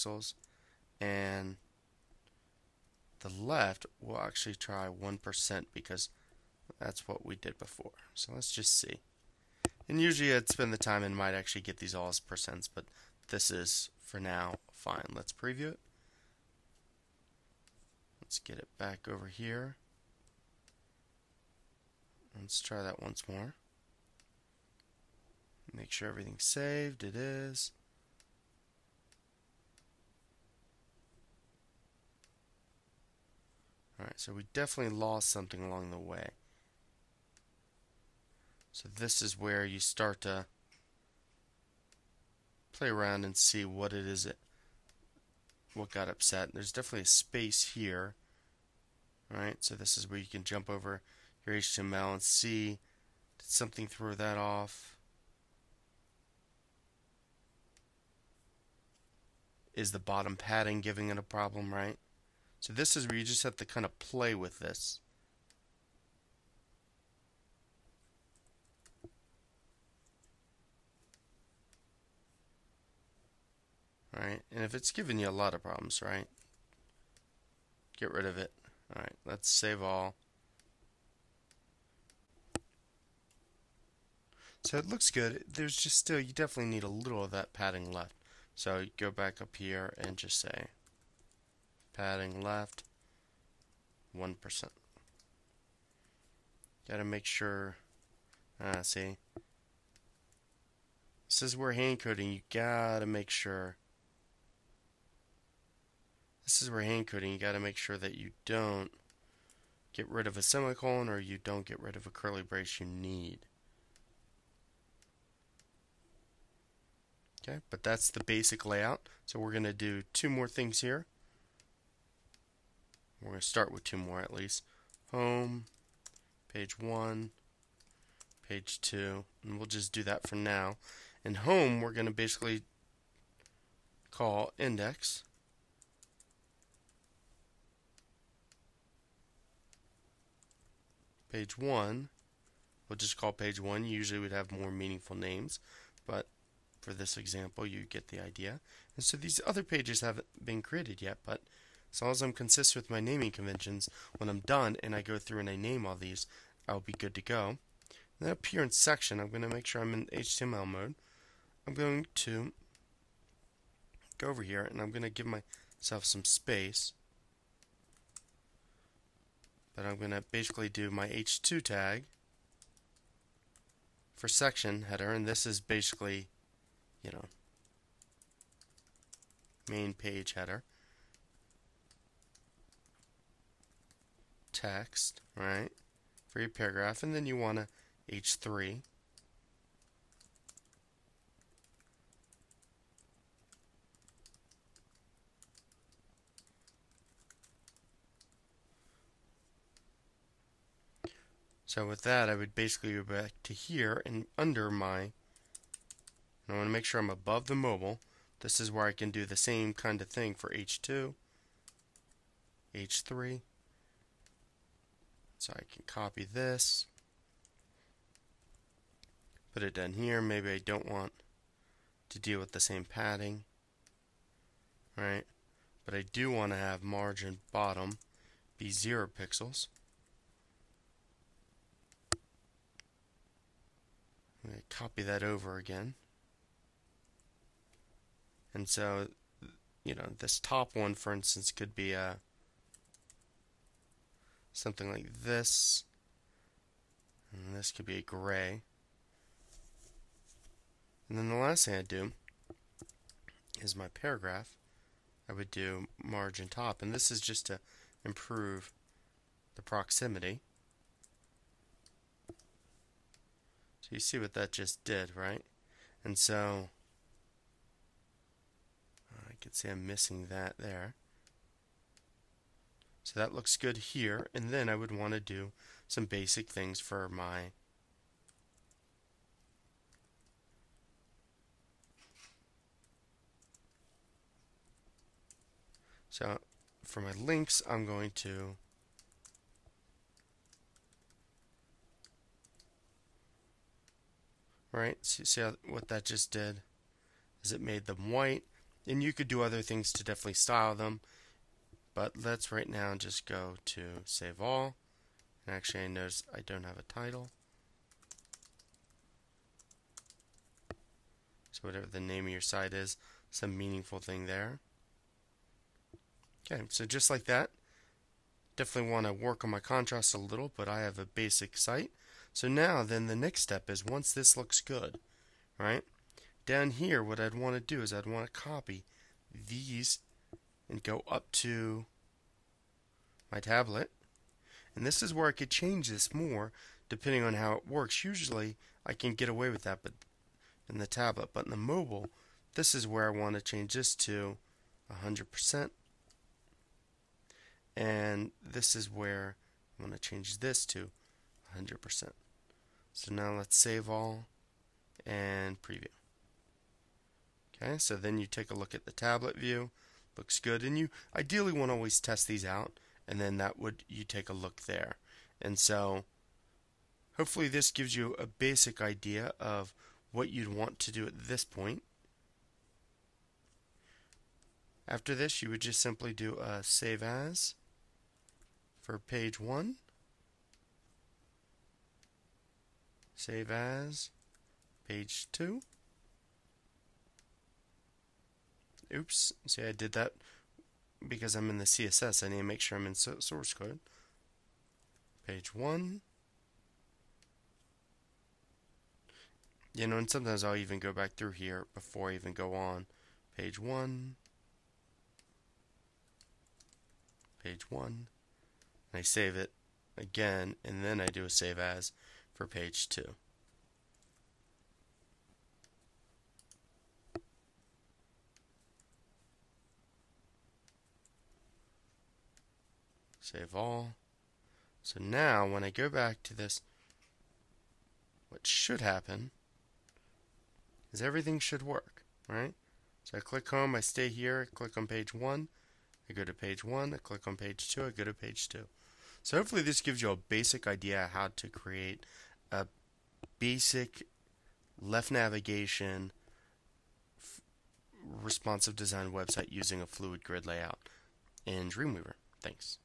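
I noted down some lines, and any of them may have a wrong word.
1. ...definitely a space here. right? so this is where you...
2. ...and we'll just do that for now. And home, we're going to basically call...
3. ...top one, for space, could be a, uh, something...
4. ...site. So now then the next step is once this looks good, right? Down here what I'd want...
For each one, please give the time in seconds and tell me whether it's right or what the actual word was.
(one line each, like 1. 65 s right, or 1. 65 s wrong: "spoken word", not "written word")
1. 46 s right
2. 129 s right
3. 240 s wrong: "instance", not "space"
4. 321 s right.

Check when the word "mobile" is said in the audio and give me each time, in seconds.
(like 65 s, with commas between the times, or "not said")
207 s, 341 s.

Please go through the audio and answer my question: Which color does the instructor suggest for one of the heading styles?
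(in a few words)
gray.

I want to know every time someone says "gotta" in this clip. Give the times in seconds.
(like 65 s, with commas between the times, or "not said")
96 s, 102 s.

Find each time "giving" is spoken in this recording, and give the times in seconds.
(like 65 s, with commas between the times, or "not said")
60 s, 74 s.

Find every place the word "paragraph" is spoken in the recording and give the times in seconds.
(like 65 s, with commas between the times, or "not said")
186 s, 253 s.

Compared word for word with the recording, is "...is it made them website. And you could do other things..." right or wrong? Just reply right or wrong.
wrong.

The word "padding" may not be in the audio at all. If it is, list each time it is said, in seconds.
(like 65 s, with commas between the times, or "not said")
60 s, 87 s, 91 s, 222 s.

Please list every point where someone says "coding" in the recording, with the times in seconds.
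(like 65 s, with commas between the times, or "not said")
101 s, 107 s.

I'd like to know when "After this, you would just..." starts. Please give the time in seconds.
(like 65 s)
374 s.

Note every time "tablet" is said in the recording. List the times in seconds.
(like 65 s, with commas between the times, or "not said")
333 s, 340 s, 358 s.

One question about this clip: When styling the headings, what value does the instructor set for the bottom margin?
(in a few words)
0 pixels.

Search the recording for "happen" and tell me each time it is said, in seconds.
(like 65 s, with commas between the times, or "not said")
428 s.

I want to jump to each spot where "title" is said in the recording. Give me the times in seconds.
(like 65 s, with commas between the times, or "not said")
306 s.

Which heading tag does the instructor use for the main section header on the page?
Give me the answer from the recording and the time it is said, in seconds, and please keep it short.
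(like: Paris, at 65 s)
h2, at 171 s.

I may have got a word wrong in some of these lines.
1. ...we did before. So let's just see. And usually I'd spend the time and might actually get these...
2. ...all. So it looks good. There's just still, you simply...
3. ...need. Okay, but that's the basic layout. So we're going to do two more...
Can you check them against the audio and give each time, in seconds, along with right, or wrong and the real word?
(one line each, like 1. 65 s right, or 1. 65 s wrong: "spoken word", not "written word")
1. 7 s right
2. 79 s wrong: "definitely", not "simply"
3. 112 s right.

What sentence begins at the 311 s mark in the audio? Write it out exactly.
So whatever the name of your site is, some meaningful thing there.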